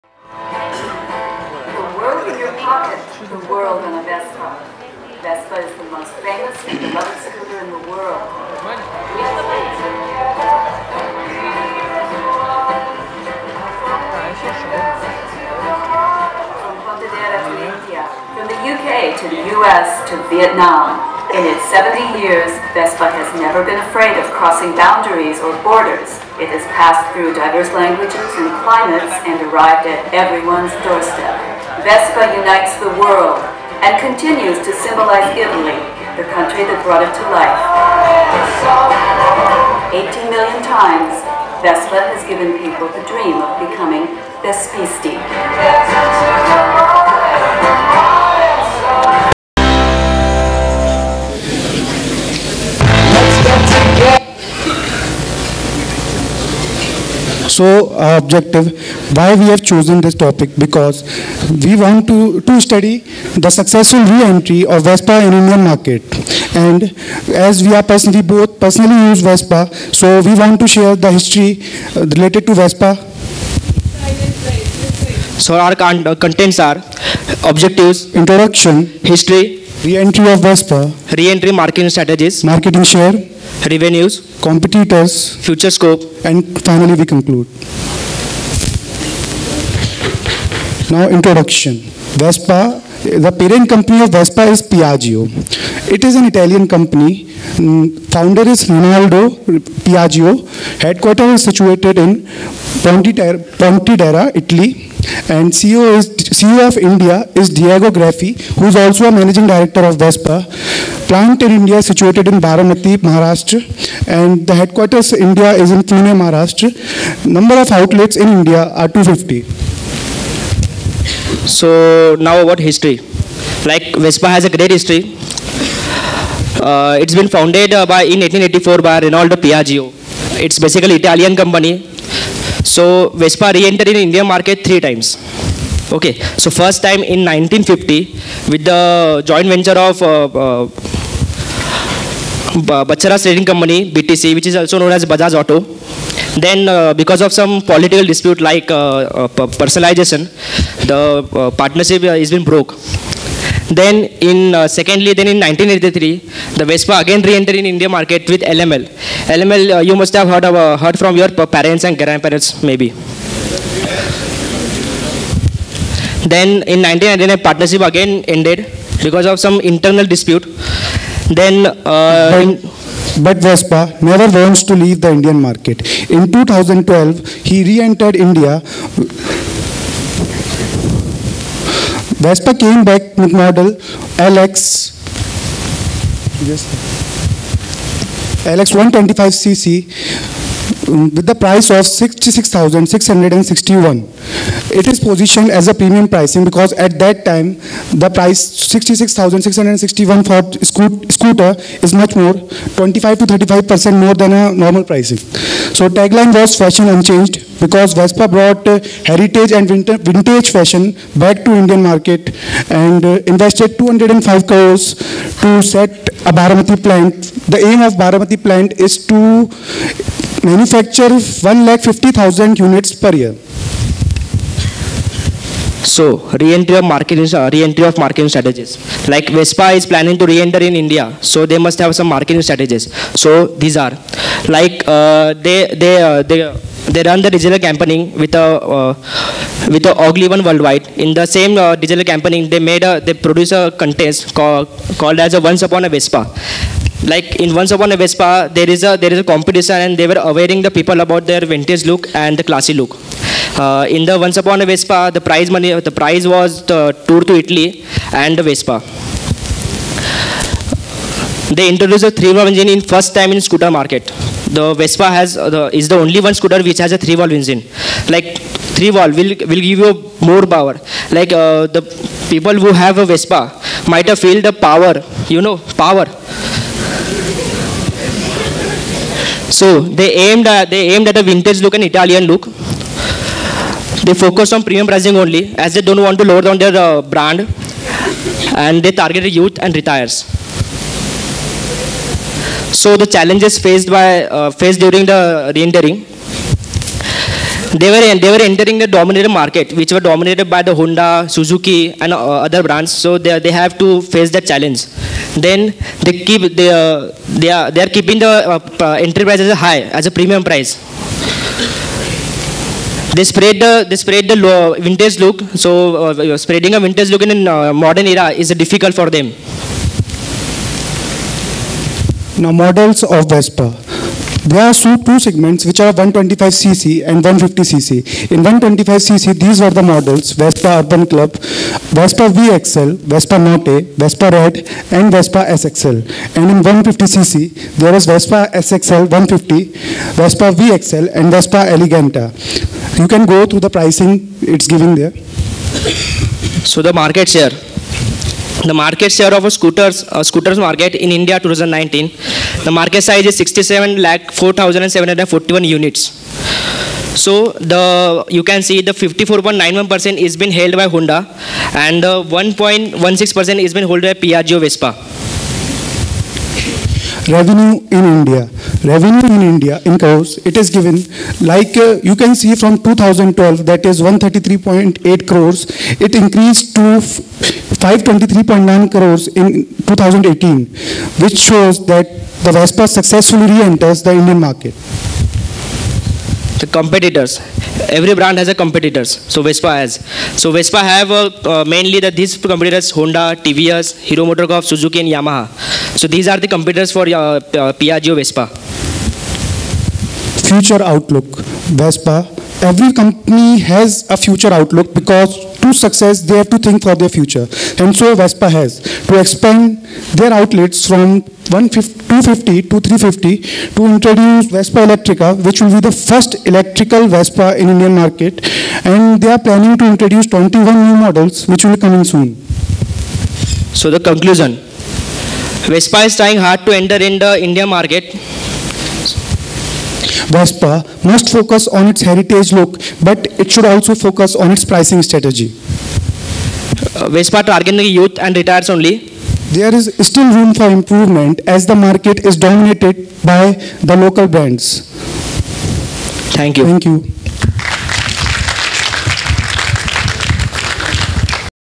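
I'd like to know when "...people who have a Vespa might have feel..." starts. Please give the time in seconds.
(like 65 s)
272 s.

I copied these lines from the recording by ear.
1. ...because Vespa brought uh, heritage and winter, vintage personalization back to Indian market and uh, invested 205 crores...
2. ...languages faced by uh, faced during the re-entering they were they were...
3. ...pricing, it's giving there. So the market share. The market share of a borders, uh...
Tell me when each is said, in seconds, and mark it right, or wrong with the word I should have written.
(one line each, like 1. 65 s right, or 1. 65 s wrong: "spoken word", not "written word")
1. 207 s wrong: "fashion", not "personalization"
2. 293 s wrong: "challenges", not "languages"
3. 343 s wrong: "scooters", not "borders".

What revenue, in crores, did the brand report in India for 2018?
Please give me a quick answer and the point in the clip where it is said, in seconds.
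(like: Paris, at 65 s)
523.9 crores, at 377 s.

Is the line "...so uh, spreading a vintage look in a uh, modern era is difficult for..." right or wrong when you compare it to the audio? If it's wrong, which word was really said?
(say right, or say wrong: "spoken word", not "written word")
right.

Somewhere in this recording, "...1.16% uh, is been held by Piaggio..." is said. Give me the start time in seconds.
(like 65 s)
362 s.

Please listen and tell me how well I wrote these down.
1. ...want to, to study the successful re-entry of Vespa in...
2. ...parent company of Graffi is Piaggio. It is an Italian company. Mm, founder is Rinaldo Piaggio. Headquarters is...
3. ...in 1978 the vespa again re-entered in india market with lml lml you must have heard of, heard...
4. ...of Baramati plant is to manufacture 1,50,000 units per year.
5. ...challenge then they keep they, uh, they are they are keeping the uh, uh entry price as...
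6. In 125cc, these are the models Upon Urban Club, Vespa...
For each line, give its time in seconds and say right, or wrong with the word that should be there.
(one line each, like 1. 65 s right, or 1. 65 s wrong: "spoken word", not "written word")
1. 61 s right
2. 93 s wrong: "Vespa", not "Graffi"
3. 155 s wrong: "1983", not "1978"
4. 217 s right
5. 304 s right
6. 328 s wrong: "Vespa", not "Upon".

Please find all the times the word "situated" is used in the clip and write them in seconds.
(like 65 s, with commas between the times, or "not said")
101 s, 111 s.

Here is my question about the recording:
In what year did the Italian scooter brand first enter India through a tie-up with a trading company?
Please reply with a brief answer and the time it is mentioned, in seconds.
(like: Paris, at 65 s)
1950, at 137 s.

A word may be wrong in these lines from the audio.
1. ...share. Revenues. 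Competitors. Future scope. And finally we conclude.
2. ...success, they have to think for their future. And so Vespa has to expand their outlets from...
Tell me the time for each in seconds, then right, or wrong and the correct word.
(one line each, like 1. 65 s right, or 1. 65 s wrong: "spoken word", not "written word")
1. 82 s right
2. 405 s right.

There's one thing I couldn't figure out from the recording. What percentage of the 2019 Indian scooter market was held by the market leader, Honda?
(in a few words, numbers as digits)
54.91%.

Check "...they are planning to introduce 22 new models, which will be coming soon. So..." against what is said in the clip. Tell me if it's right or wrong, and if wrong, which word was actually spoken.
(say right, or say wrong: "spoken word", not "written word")
wrong: "21", not "22".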